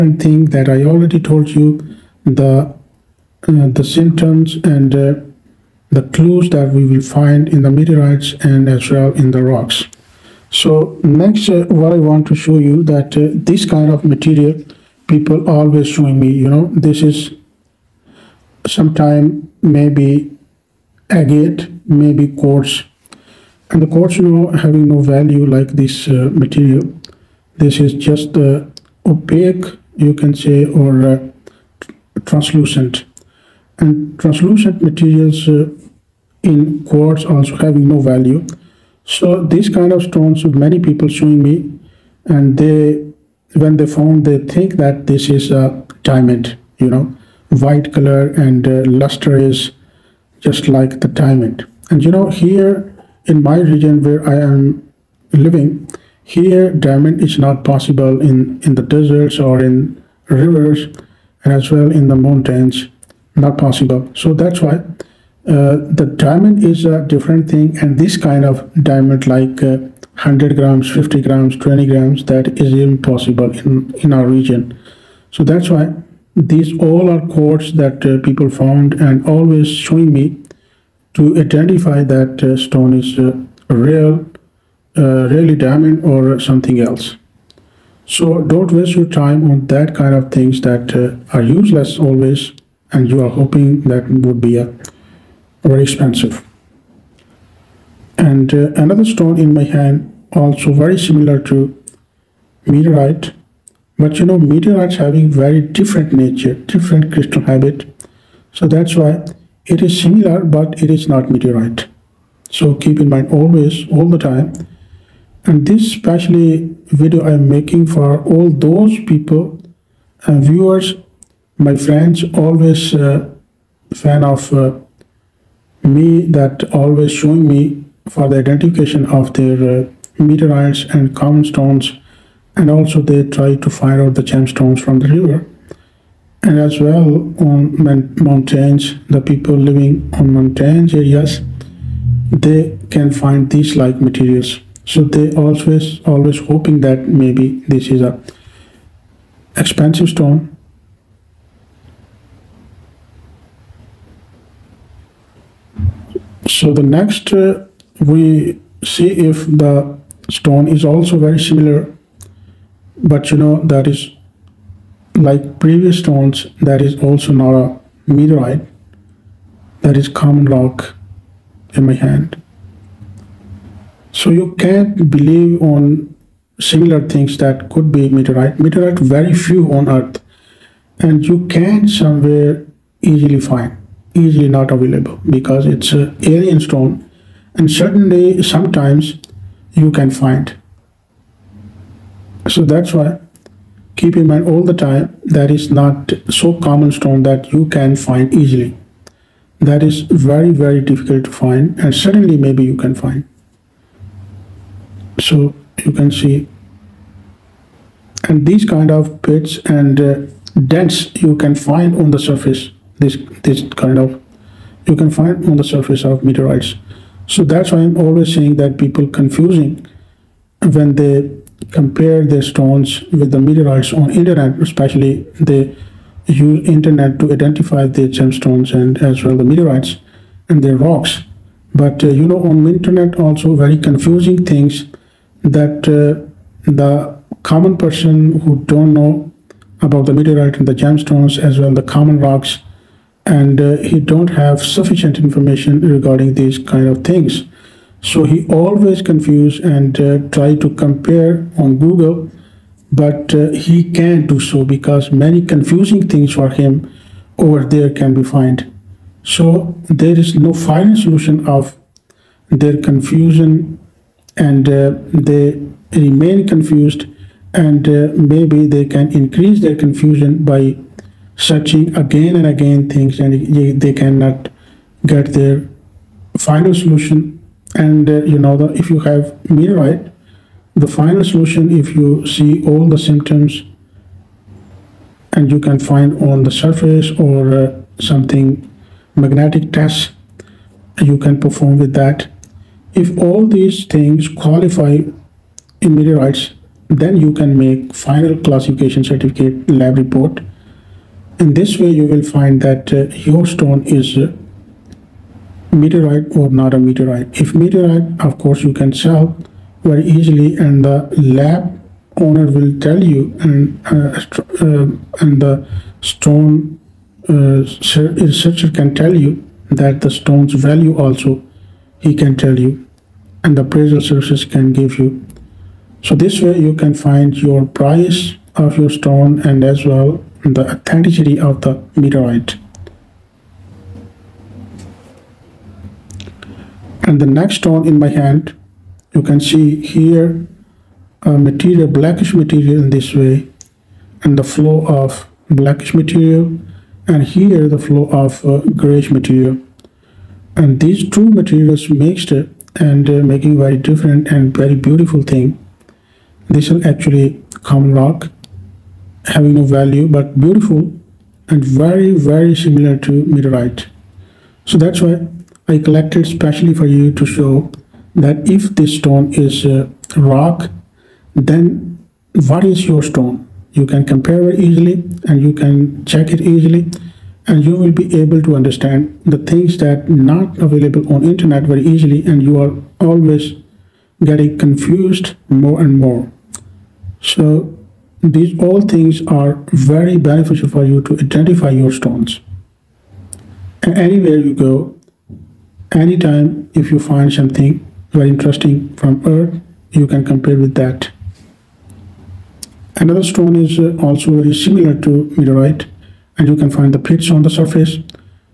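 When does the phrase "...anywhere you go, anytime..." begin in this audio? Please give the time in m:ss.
6:33.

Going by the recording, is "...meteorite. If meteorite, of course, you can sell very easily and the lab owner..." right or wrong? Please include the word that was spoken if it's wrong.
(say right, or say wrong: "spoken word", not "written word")
right.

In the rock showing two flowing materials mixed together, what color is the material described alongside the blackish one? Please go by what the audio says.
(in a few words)
grayish.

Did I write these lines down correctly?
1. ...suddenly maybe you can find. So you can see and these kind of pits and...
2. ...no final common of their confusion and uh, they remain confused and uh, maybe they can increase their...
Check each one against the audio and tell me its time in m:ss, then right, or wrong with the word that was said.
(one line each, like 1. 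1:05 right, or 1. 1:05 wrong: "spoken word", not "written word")
1. 3:21 right
2. 4:20 wrong: "solution", not "common".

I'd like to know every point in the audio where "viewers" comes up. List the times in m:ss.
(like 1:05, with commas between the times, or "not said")
2:00.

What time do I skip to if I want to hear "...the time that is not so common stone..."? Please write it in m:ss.
3:14.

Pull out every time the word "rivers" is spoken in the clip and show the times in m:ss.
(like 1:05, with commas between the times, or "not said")
1:00, 2:15.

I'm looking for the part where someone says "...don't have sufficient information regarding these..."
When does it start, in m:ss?
4:03.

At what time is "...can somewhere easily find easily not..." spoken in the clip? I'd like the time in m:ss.
3:01.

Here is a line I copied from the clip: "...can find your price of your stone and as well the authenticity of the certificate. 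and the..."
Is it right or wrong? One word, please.
wrong.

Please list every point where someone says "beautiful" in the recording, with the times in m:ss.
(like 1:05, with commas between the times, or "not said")
5:54, 6:00.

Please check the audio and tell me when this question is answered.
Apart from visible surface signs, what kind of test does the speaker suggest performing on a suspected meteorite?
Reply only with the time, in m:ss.
4:49.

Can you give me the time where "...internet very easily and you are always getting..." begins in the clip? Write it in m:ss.
6:21.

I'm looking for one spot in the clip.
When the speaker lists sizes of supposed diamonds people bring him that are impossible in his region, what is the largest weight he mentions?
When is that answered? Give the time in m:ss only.
1:10.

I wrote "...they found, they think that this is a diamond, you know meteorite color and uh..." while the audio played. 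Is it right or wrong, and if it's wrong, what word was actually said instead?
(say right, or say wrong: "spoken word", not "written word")
wrong: "white", not "meteorite".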